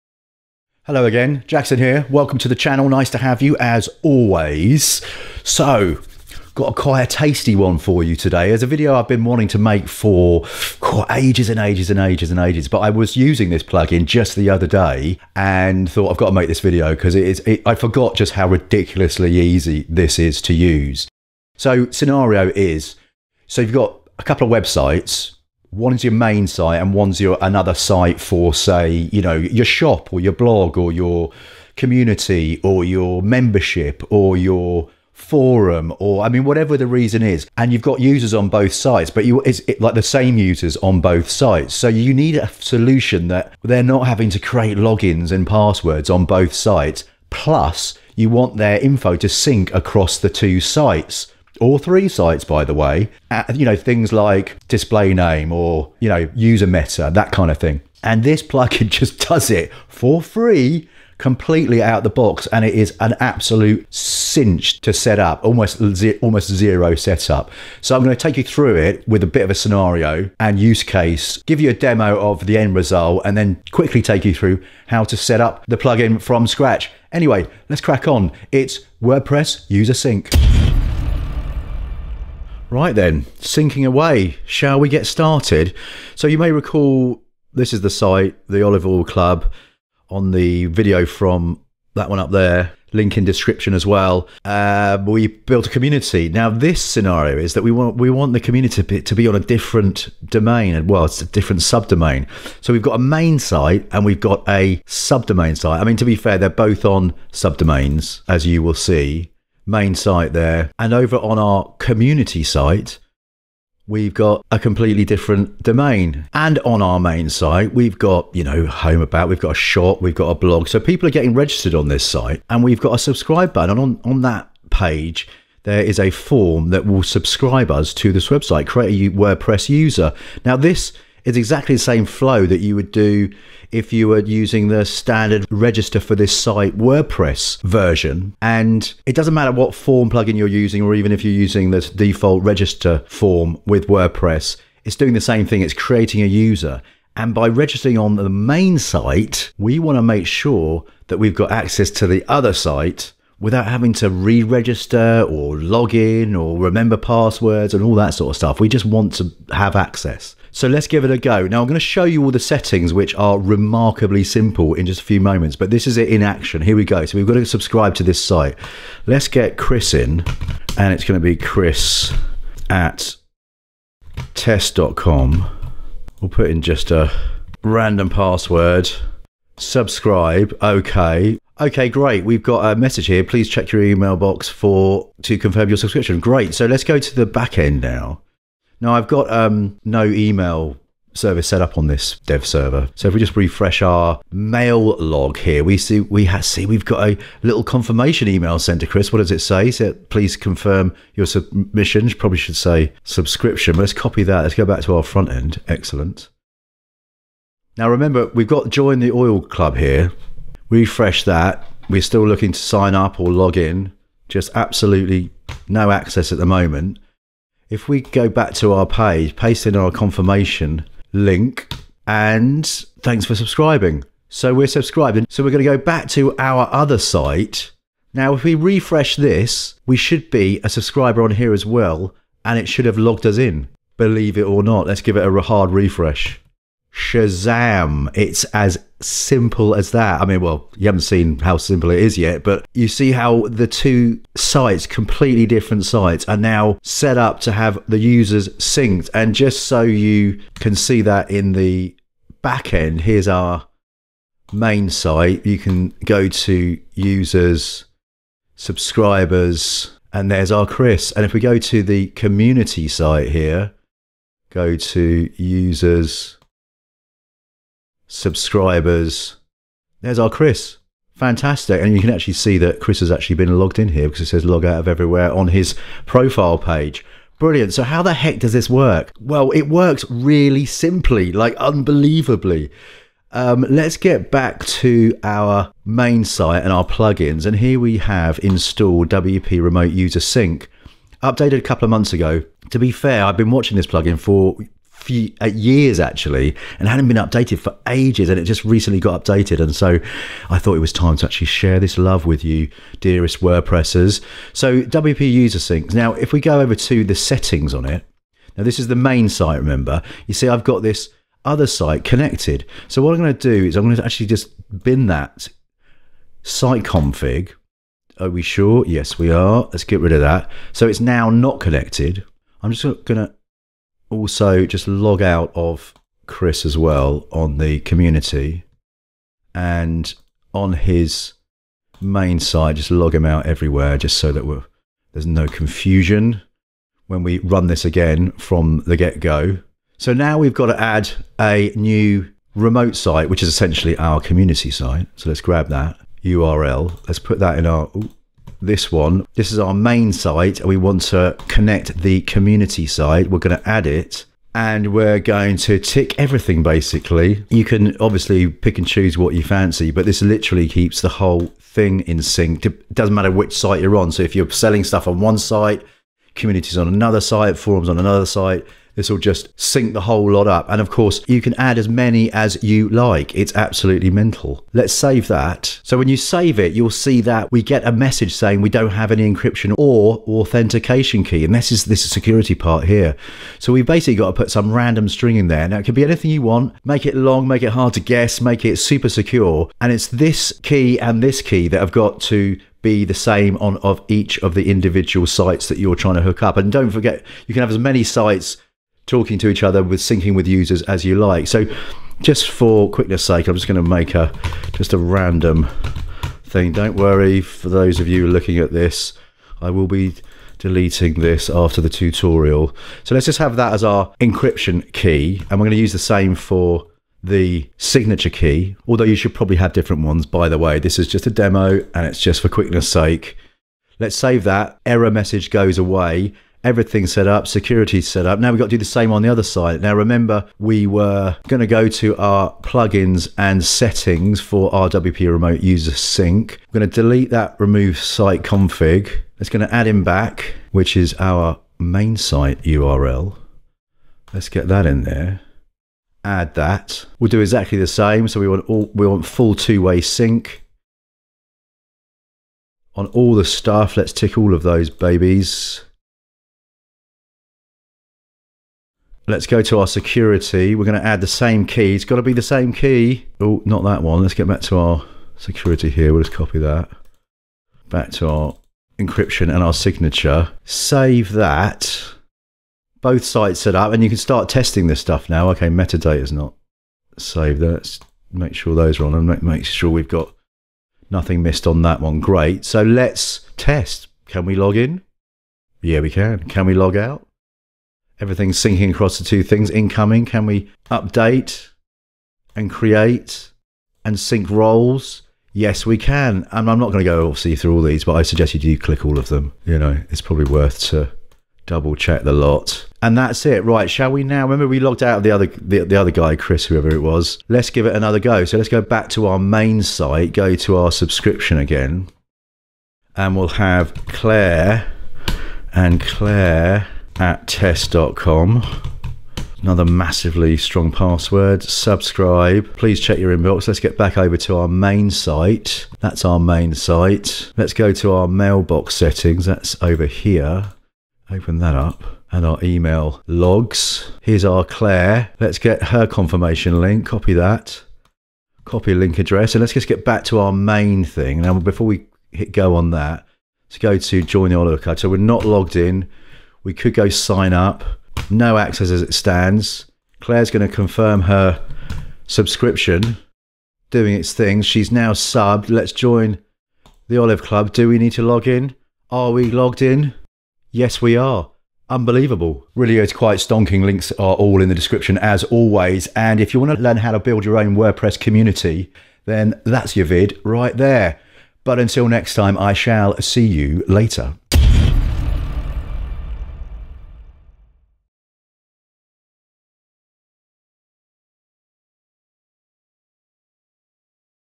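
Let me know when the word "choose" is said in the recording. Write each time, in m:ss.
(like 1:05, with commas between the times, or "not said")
5:58.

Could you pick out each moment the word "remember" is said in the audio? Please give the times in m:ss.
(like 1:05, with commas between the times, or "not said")
2:36, 3:27, 5:09, 7:09, 8:24.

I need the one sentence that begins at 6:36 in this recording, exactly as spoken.
And don't forget, you can have as many sites talking to each other with syncing with users as you like.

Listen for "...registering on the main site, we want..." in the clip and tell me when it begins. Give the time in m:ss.
2:27.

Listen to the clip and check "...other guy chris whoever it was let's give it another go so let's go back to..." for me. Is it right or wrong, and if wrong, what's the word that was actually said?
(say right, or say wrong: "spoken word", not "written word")
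right.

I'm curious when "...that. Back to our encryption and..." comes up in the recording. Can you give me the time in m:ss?
7:46.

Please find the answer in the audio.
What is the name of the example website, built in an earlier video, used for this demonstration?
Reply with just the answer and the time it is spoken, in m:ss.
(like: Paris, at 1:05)
The Olive Oil Club, at 1:28.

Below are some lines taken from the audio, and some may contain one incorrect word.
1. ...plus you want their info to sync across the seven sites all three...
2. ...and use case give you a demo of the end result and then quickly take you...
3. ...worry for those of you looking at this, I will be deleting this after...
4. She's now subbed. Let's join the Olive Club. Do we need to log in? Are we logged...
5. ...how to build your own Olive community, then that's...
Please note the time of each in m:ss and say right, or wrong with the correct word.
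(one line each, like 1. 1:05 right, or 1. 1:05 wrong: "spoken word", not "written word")
1. 0:47 wrong: "two", not "seven"
2. 1:10 right
3. 6:46 right
4. 9:14 right
5. 9:26 wrong: "WordPress", not "Olive".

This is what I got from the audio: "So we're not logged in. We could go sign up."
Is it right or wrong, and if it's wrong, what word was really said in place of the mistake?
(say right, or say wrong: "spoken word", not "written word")
right.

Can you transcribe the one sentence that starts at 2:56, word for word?
We'll put in just a random password.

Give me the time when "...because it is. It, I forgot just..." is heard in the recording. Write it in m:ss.
0:16.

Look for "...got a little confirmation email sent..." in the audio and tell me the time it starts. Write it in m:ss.
3:16.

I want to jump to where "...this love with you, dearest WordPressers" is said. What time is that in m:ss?
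5:01.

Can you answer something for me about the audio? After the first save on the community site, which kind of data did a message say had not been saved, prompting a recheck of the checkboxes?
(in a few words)
Metadata.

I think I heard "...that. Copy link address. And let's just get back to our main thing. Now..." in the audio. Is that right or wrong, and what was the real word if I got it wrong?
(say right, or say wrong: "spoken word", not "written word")
right.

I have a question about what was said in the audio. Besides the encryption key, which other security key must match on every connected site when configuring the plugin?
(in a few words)
Signature key.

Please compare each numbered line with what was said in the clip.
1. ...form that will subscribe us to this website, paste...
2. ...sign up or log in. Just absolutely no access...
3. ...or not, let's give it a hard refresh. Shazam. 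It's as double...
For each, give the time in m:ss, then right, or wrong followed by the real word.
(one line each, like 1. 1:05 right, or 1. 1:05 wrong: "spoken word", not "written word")
1. 2:06 wrong: "create", not "paste"
2. 3:32 right
3. 3:54 wrong: "simple", not "double".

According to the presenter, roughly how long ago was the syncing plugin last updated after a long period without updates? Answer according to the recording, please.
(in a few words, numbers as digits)
A couple of months.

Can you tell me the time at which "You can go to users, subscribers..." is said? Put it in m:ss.
4:15.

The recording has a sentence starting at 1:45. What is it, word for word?
I mean, to be fair, they're both on subdomains, as you will see main site there.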